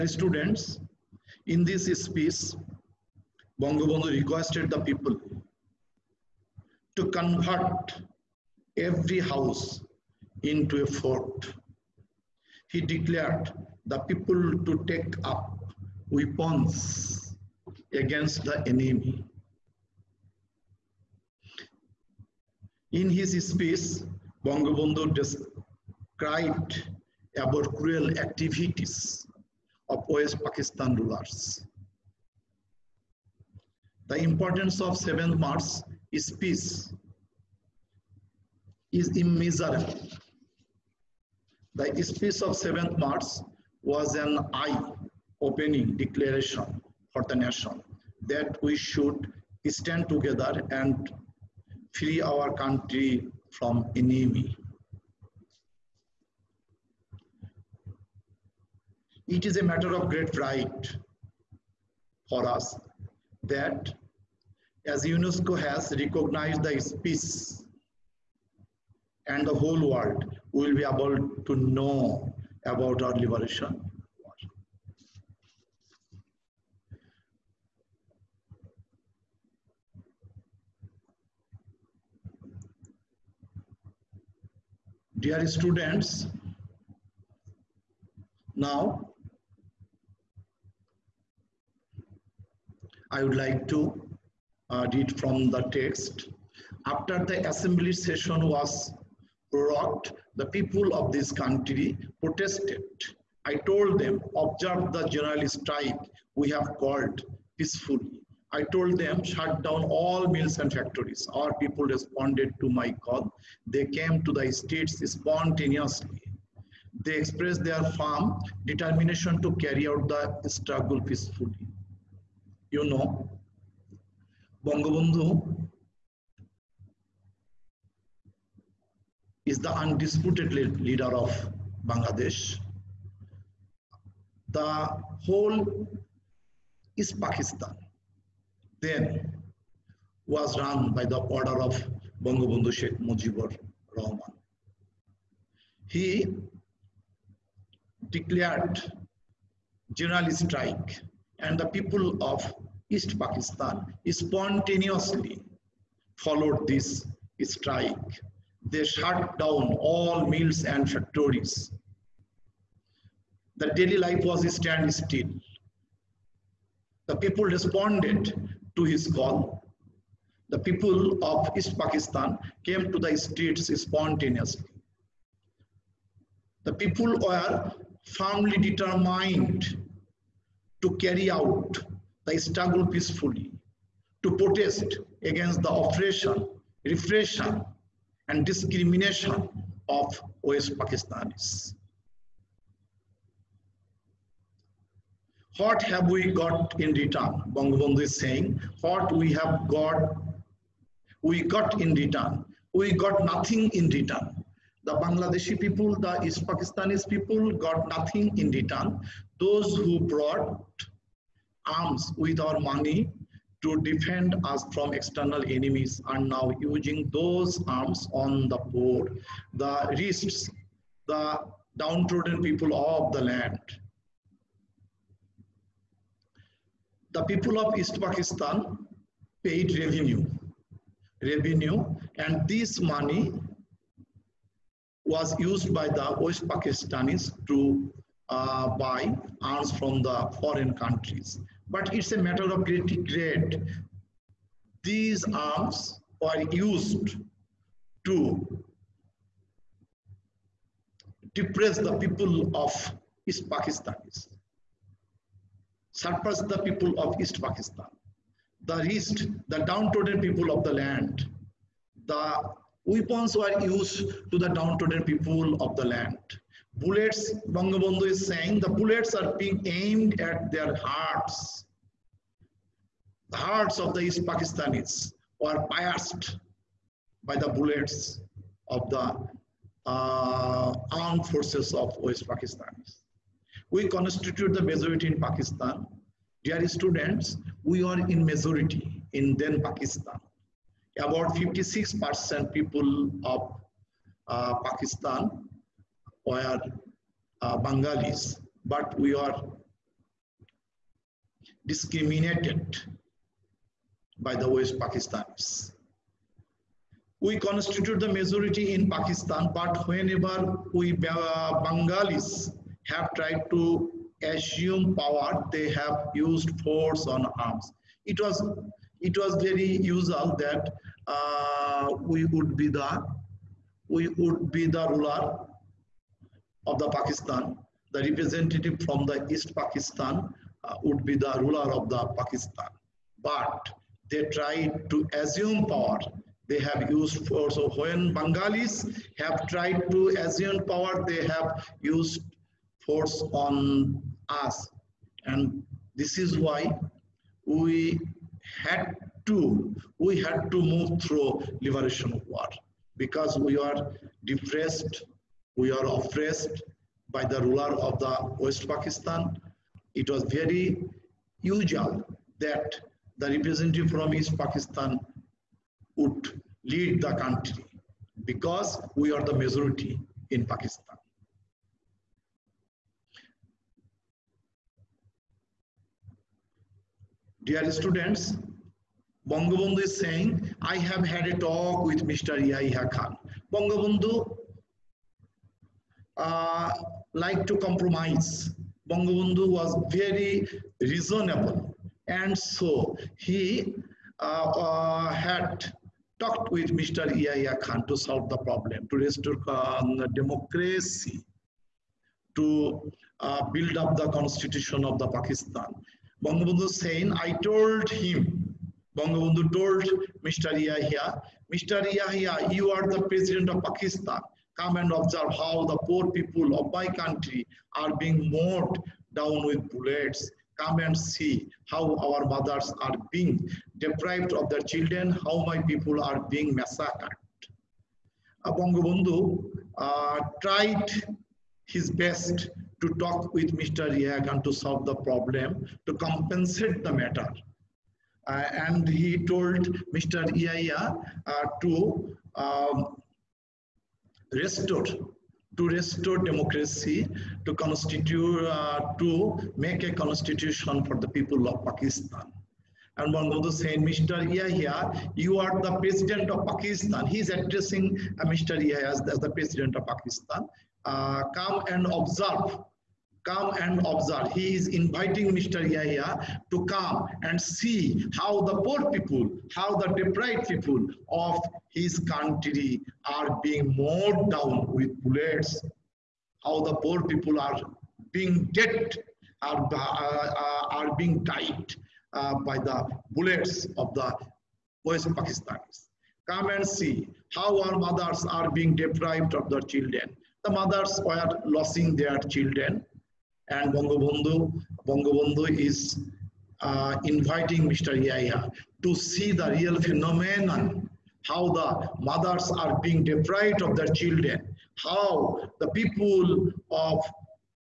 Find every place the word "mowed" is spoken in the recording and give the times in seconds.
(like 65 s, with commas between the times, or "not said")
418 s, 473 s.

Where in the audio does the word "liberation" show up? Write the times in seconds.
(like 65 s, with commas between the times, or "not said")
73 s, 351 s.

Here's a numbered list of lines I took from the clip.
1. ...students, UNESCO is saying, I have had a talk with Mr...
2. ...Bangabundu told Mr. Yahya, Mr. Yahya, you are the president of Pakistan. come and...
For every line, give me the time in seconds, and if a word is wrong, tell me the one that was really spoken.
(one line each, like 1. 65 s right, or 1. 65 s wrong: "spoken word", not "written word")
1. 377 s wrong: "Bangabandhu", not "UNESCO"
2. 408 s right.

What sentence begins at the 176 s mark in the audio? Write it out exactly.
The people were firmly determined to carry out the struggle peacefully, to protest against the oppression, repression, and discrimination of West Pakistanis.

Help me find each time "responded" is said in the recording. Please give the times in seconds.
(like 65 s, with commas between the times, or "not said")
111 s, 167 s.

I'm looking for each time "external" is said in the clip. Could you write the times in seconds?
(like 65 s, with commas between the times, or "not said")
214 s.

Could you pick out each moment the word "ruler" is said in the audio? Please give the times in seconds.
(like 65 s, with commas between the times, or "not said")
30 s, 324 s, 331 s, 357 s.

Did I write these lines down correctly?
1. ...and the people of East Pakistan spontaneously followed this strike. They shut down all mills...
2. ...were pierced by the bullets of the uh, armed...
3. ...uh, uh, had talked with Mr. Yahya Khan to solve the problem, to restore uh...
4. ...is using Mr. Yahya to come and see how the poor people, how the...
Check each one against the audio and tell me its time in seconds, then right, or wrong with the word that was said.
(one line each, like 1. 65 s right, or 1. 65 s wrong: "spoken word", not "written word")
1. 151 s right
2. 275 s right
3. 394 s right
4. 464 s wrong: "inviting", not "using".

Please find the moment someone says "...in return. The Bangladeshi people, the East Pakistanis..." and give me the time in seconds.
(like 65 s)
203 s.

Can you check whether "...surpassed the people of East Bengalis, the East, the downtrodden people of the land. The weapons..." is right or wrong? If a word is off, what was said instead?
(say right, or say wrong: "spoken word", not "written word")
wrong: "Pakistan", not "Bengalis".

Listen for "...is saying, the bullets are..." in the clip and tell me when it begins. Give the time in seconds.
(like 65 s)
268 s.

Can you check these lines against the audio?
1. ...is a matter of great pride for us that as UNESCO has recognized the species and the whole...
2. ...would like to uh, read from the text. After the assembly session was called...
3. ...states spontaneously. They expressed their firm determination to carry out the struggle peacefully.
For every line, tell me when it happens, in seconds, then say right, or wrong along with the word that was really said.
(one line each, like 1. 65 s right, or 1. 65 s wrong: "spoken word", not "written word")
1. 59 s right
2. 93 s wrong: "prorogued", not "called"
3. 114 s right.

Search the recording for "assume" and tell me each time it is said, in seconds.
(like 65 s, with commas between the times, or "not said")
314 s, 335 s, 340 s.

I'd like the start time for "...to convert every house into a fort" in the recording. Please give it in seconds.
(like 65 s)
6 s.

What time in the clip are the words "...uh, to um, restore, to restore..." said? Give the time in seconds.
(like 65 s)
441 s.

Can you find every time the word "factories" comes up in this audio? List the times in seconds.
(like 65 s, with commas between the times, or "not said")
110 s, 160 s.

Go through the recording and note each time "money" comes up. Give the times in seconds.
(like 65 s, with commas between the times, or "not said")
212 s, 232 s.